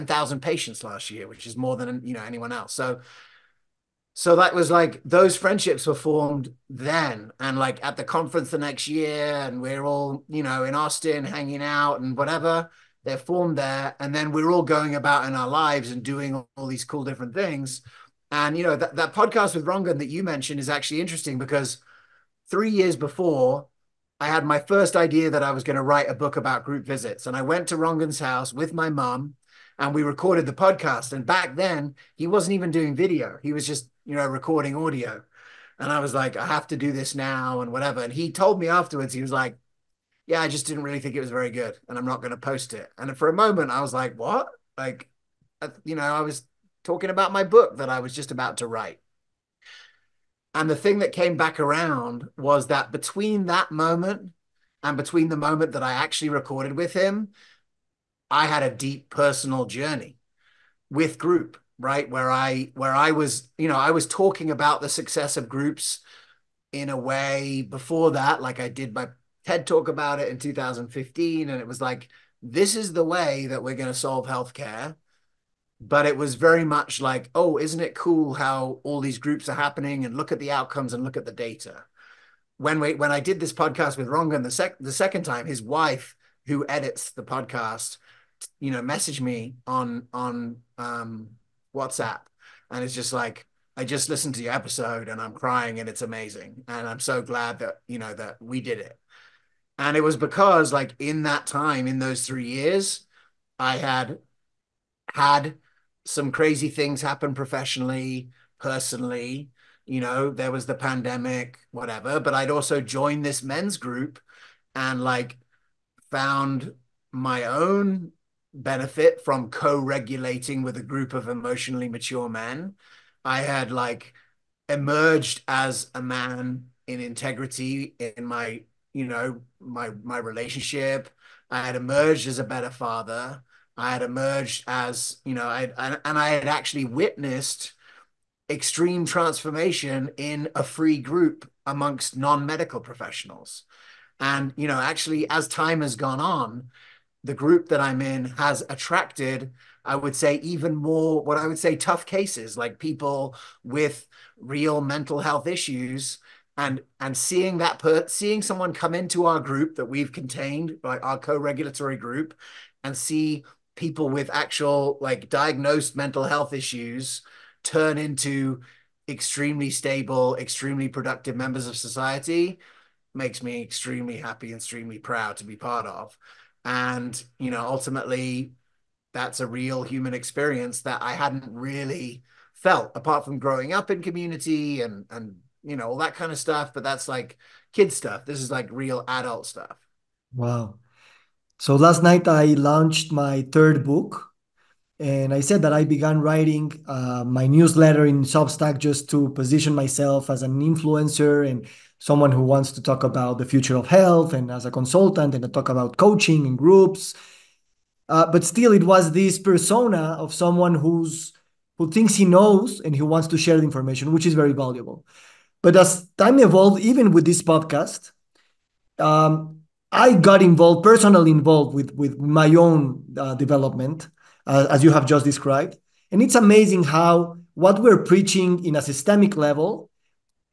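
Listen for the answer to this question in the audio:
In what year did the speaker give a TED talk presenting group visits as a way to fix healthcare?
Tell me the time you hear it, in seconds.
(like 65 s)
70 s.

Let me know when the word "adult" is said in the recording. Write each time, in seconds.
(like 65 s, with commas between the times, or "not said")
189 s.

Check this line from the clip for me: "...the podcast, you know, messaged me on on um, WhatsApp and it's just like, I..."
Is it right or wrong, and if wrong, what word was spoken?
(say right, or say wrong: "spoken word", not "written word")
right.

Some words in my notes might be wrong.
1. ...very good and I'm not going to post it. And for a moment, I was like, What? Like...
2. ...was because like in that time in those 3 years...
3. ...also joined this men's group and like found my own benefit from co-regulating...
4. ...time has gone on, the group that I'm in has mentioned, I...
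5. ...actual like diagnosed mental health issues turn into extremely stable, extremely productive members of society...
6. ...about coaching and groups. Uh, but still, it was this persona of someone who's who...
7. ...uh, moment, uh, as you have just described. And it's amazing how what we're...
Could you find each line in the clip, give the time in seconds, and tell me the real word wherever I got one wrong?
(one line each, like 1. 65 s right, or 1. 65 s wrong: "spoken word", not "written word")
1. 41 s right
2. 100 s right
3. 112 s right
4. 145 s wrong: "attracted", not "mentioned"
5. 164 s right
6. 205 s right
7. 223 s wrong: "development", not "moment".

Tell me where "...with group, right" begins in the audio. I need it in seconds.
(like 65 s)
60 s.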